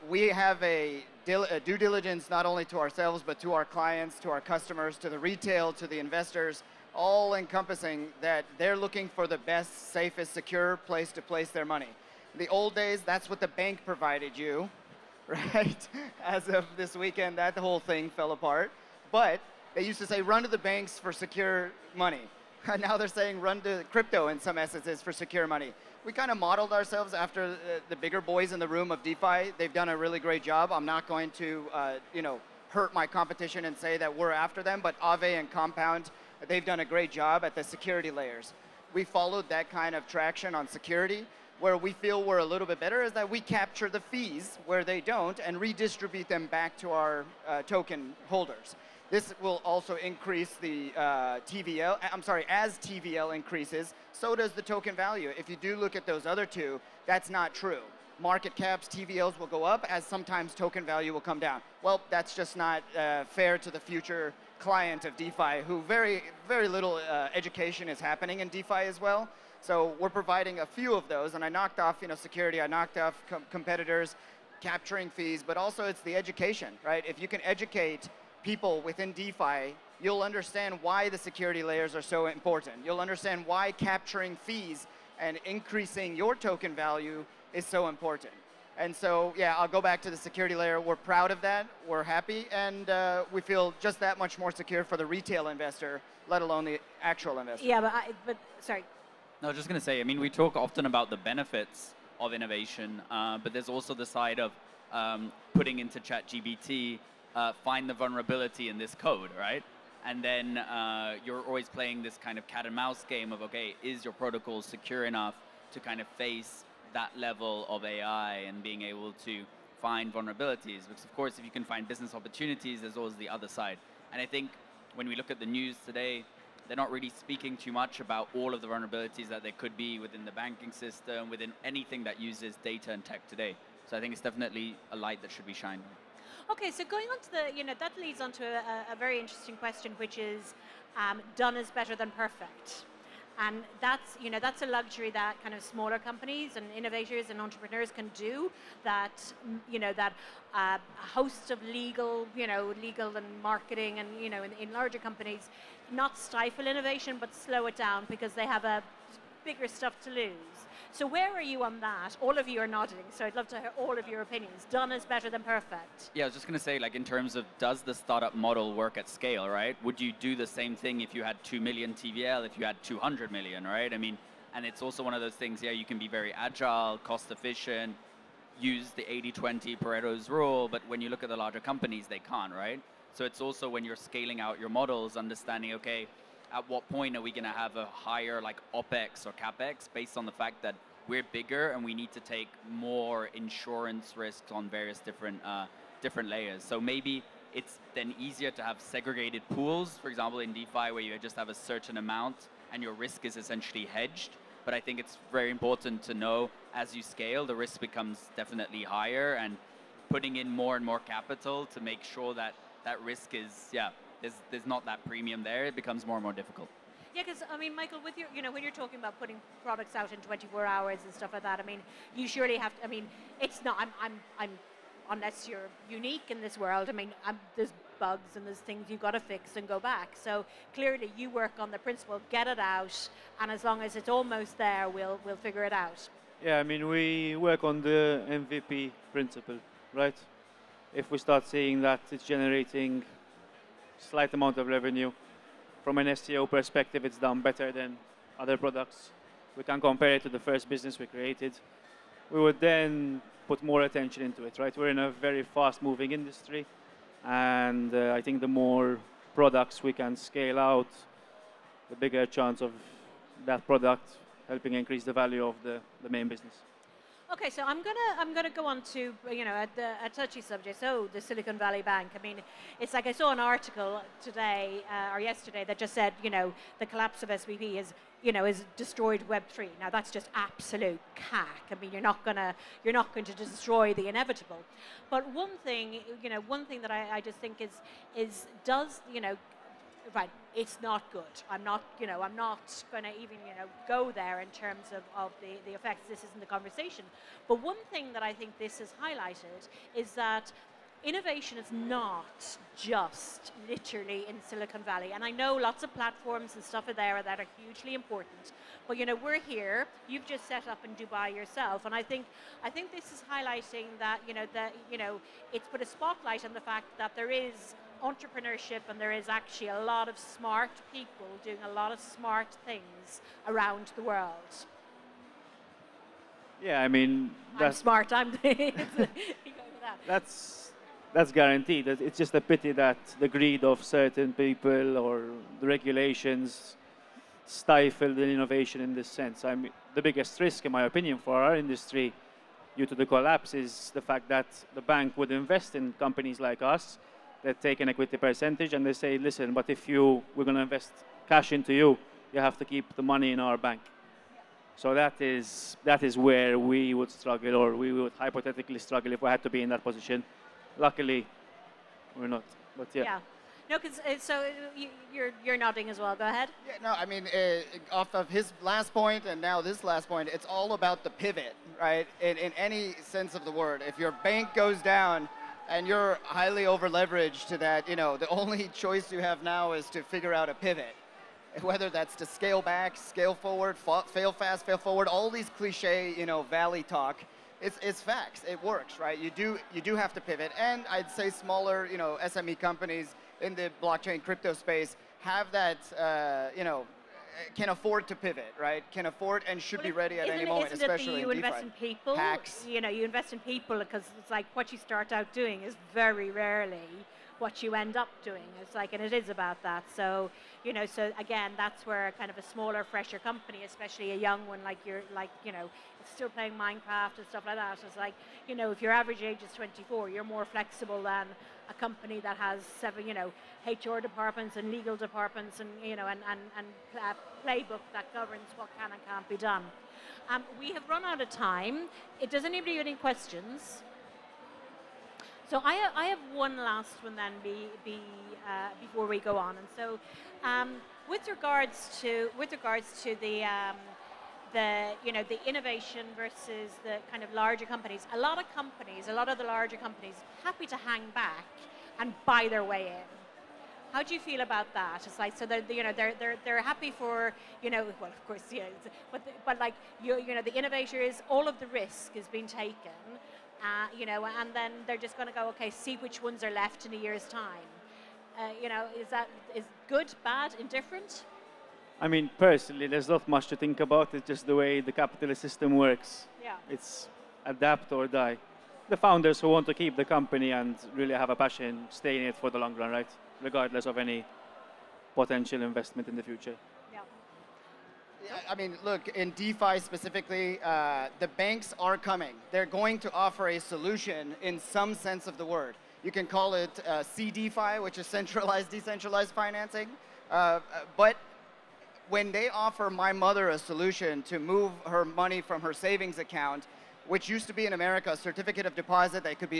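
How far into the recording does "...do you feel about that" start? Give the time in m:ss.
7:34.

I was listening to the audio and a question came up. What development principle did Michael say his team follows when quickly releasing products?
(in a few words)
MVP principle.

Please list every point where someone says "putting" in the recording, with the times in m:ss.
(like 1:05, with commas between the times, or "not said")
1:45, 3:30, 3:39.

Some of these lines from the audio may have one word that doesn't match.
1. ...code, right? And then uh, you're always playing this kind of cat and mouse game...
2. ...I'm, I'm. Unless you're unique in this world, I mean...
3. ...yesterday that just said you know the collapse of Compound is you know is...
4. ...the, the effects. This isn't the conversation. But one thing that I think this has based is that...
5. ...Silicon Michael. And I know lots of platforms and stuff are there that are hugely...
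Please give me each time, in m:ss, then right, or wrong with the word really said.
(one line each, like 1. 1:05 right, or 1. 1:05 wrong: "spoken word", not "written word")
1. 1:48 right
2. 3:44 right
3. 4:35 wrong: "SVB", not "Compound"
4. 4:55 wrong: "highlighted", not "based"
5. 5:04 wrong: "Valley", not "Michael".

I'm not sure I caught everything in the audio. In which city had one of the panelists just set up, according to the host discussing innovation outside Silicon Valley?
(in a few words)
Dubai.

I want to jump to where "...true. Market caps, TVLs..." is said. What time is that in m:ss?
0:57.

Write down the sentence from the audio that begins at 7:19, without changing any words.
And so um, with regards to, with regards to the, um, the, you know, the innovation versus the kind of larger companies.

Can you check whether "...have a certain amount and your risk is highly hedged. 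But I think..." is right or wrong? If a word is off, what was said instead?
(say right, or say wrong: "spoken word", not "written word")
wrong: "essentially", not "highly".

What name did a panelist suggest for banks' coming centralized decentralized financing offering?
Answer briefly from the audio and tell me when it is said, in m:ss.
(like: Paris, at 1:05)
CDFI, at 8:17.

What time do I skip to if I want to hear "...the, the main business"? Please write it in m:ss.
4:25.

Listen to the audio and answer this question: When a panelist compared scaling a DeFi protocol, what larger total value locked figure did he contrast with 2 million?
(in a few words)
200 million.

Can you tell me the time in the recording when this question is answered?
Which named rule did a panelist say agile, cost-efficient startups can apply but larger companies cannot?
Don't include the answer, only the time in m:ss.
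2:59.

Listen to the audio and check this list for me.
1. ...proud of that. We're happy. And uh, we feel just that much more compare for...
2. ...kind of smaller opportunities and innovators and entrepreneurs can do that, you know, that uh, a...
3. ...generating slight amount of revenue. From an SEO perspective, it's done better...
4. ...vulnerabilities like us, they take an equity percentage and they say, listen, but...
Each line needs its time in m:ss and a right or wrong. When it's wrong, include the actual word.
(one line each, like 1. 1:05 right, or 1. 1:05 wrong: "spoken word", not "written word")
1. 1:30 wrong: "secure", not "compare"
2. 2:25 wrong: "companies", not "opportunities"
3. 4:02 right
4. 5:45 wrong: "companies", not "vulnerabilities".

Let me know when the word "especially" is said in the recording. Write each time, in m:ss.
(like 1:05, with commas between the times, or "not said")
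6:40, 6:53.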